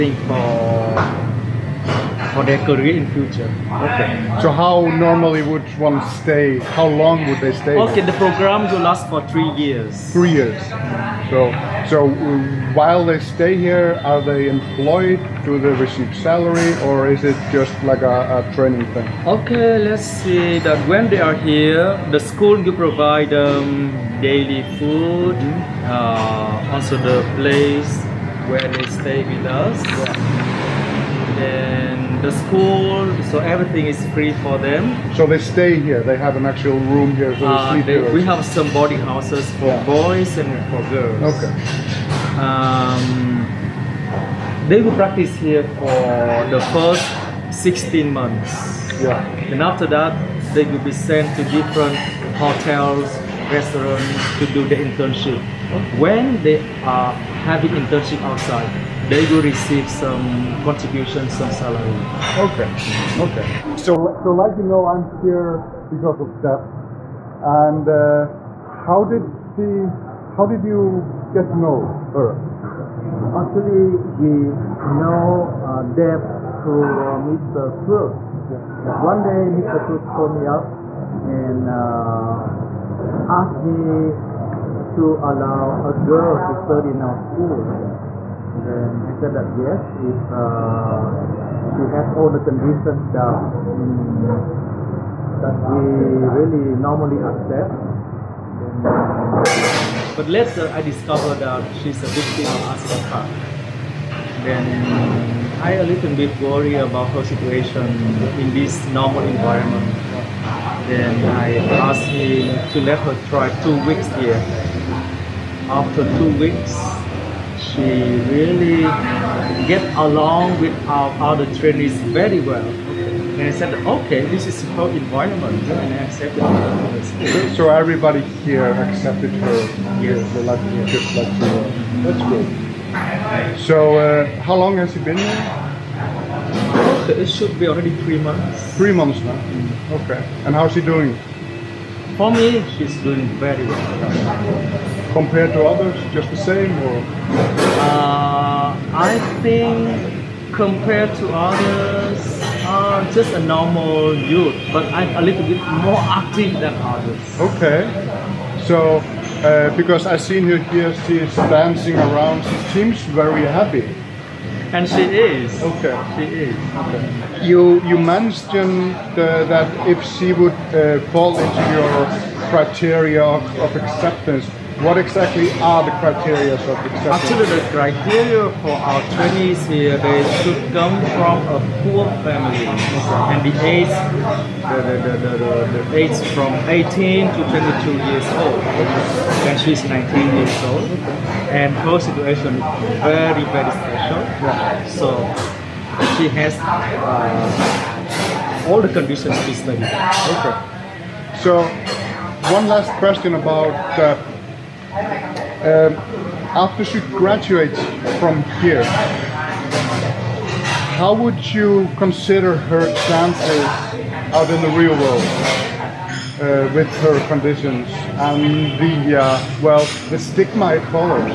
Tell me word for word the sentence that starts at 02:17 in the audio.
it should be already three months.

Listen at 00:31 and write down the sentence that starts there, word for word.
Yeah the school, so everything is free for them.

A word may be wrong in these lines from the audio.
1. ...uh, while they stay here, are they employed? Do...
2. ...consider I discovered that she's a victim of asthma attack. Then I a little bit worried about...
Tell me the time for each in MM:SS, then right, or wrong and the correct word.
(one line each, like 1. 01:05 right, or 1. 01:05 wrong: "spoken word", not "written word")
1. 00:12 right
2. 01:40 wrong: "later", not "consider".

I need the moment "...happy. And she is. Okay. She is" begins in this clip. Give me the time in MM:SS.
02:43.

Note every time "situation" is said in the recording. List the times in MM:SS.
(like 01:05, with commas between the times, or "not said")
01:47, 03:11.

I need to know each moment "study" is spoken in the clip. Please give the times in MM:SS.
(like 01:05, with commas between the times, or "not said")
01:26, 03:19.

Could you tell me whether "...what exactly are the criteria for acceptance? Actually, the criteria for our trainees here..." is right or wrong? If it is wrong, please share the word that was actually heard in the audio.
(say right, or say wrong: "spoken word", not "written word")
right.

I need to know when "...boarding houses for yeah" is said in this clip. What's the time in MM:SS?
00:38.